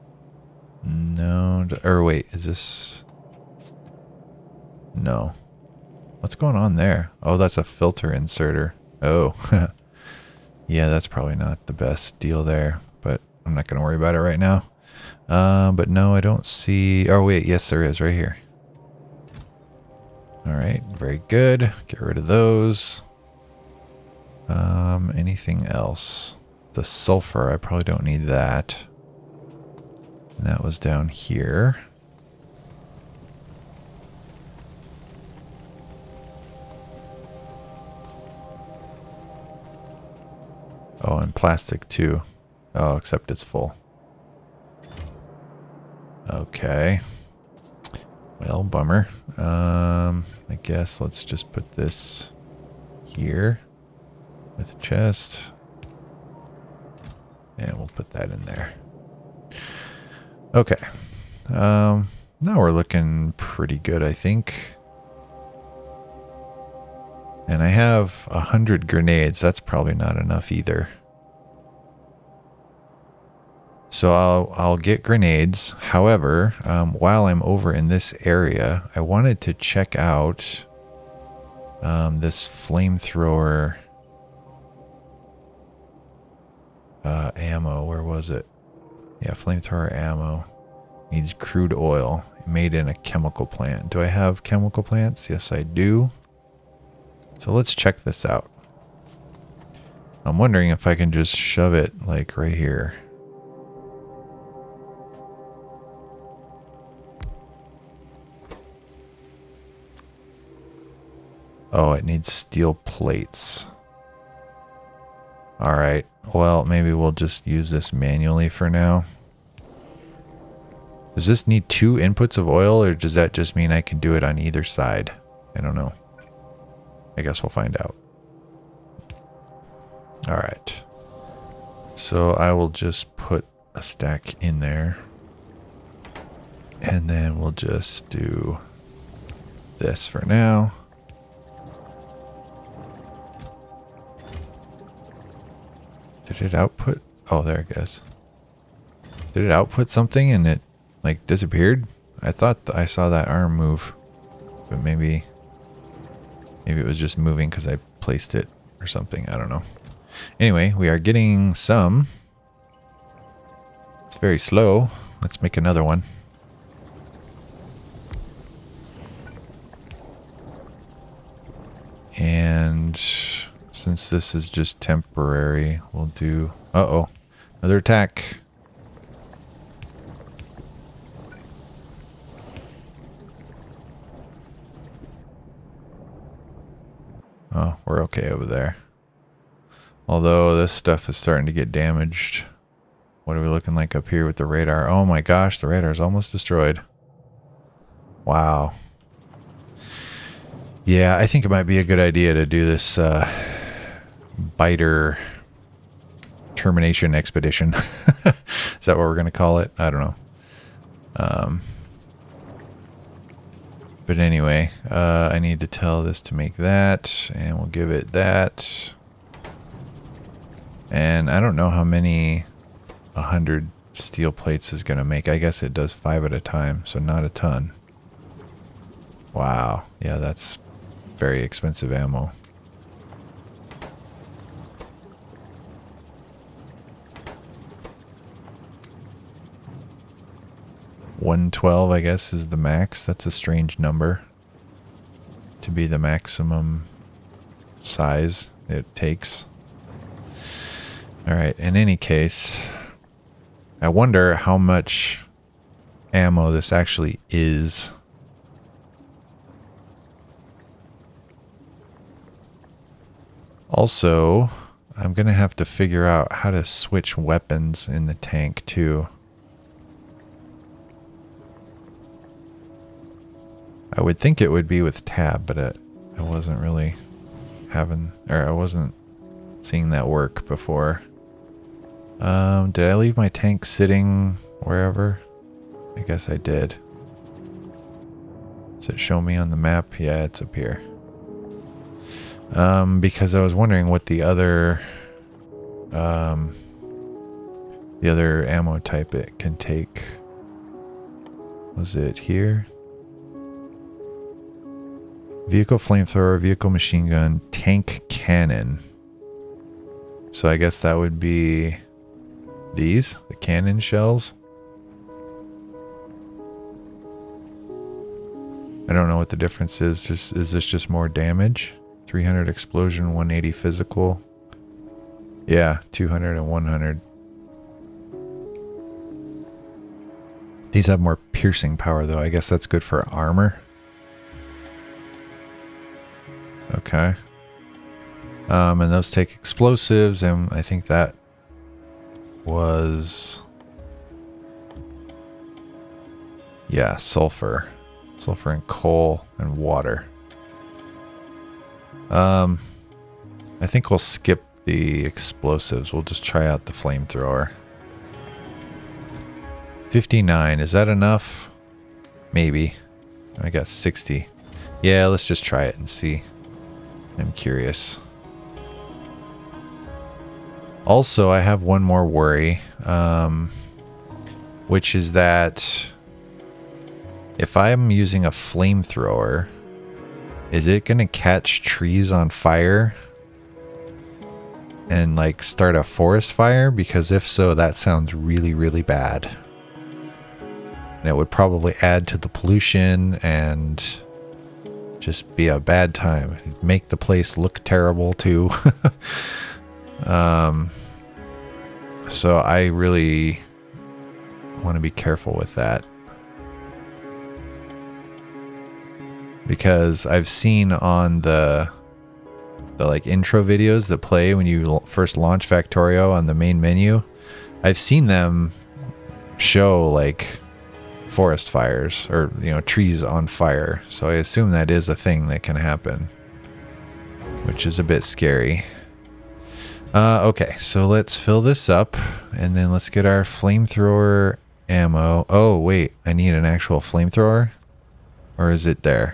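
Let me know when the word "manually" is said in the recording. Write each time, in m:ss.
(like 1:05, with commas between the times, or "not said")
1:57.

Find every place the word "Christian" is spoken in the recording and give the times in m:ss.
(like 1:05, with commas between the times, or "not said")
not said.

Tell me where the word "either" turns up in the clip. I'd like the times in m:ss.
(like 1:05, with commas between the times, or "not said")
1:10, 2:04.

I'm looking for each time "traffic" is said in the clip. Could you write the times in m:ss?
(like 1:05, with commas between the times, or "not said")
not said.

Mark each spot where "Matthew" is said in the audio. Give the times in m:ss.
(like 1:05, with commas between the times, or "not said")
not said.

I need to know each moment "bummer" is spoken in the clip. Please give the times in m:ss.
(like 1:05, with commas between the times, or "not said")
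0:48.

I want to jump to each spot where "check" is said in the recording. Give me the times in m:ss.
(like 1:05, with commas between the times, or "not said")
1:19, 1:37.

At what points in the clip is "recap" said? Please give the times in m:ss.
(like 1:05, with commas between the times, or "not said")
not said.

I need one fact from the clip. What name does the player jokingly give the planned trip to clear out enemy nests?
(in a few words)
biter termination expedition.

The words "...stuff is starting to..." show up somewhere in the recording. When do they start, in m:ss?
3:10.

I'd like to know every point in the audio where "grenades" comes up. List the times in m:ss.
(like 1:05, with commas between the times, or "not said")
1:08, 1:15.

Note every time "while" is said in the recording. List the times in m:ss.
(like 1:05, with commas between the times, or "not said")
1:16.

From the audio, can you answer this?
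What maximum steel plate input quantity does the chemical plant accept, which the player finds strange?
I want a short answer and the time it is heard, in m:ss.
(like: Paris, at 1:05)
112, at 4:01.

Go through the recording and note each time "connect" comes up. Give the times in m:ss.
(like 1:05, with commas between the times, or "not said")
not said.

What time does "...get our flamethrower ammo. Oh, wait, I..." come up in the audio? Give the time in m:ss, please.
7:12.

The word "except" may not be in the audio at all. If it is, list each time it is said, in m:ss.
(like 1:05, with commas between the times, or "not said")
0:42.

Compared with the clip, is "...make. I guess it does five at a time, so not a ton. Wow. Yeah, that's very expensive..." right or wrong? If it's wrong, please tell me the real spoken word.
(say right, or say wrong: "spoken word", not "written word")
right.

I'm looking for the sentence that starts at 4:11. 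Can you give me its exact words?
All right, in any case, I wonder how much ammo this actually is.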